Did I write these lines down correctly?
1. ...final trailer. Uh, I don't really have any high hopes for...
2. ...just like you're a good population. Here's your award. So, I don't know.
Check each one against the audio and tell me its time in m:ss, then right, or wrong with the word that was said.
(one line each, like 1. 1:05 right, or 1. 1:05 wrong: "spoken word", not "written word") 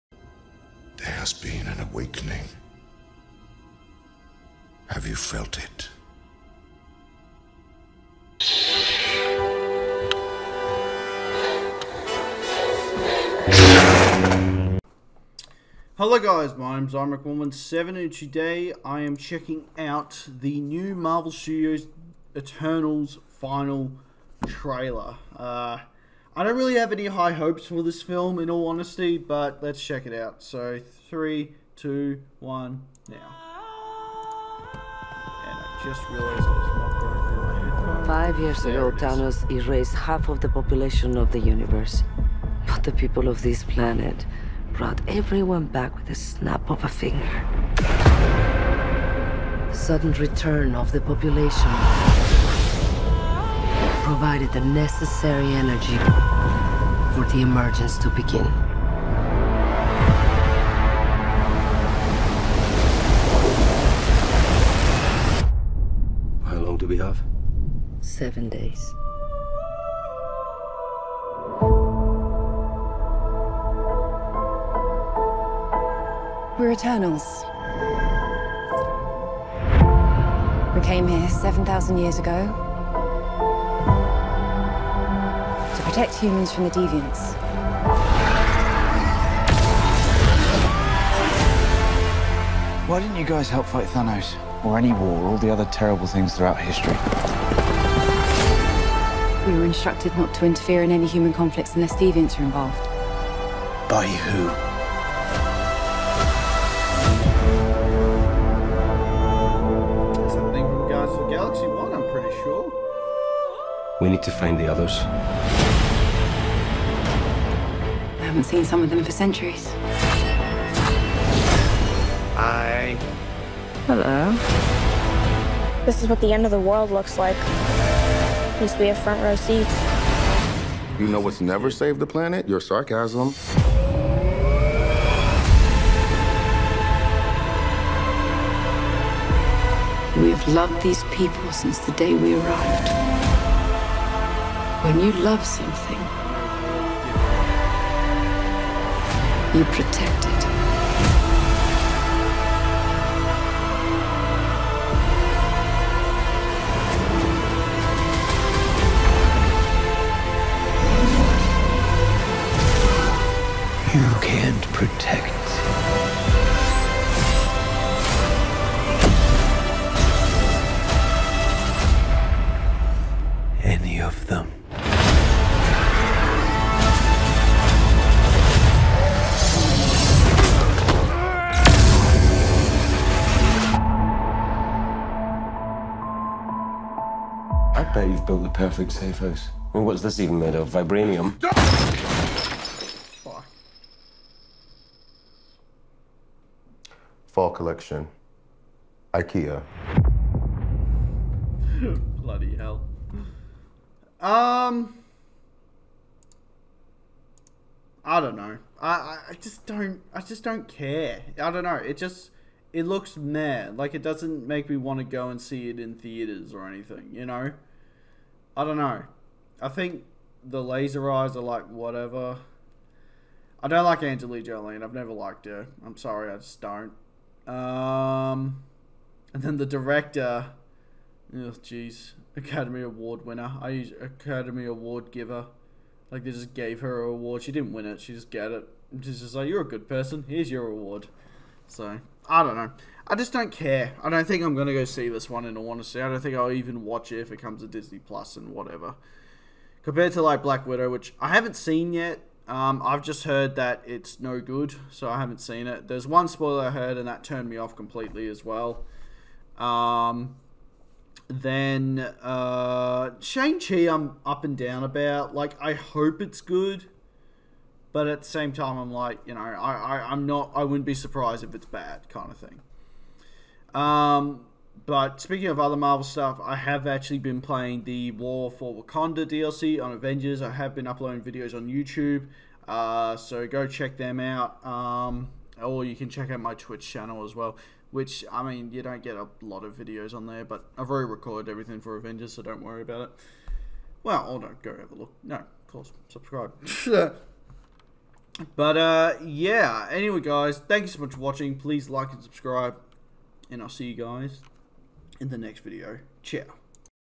1. 0:23 right
2. 3:59 wrong: "person", not "population".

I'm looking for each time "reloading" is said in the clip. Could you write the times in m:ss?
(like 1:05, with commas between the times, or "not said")
not said.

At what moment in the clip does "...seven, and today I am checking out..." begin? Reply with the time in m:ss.
0:17.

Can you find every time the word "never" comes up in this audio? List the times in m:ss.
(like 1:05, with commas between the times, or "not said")
2:11, 3:44.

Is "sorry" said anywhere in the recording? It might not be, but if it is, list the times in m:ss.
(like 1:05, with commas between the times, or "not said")
3:45.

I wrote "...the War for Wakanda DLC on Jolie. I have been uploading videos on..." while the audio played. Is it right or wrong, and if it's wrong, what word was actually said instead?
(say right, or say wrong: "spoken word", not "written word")
wrong: "Avengers", not "Jolie".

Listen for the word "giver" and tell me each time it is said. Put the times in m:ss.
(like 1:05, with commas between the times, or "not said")
3:55.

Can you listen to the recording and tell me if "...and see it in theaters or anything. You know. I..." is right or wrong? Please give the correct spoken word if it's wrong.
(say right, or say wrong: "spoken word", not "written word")
right.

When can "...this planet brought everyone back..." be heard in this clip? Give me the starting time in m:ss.
0:43.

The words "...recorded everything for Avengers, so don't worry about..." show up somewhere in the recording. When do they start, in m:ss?
4:51.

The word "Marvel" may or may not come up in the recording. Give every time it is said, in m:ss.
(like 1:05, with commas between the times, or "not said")
0:20, 4:35.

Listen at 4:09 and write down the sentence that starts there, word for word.
Compared to like Black Widow, which I haven't seen yet.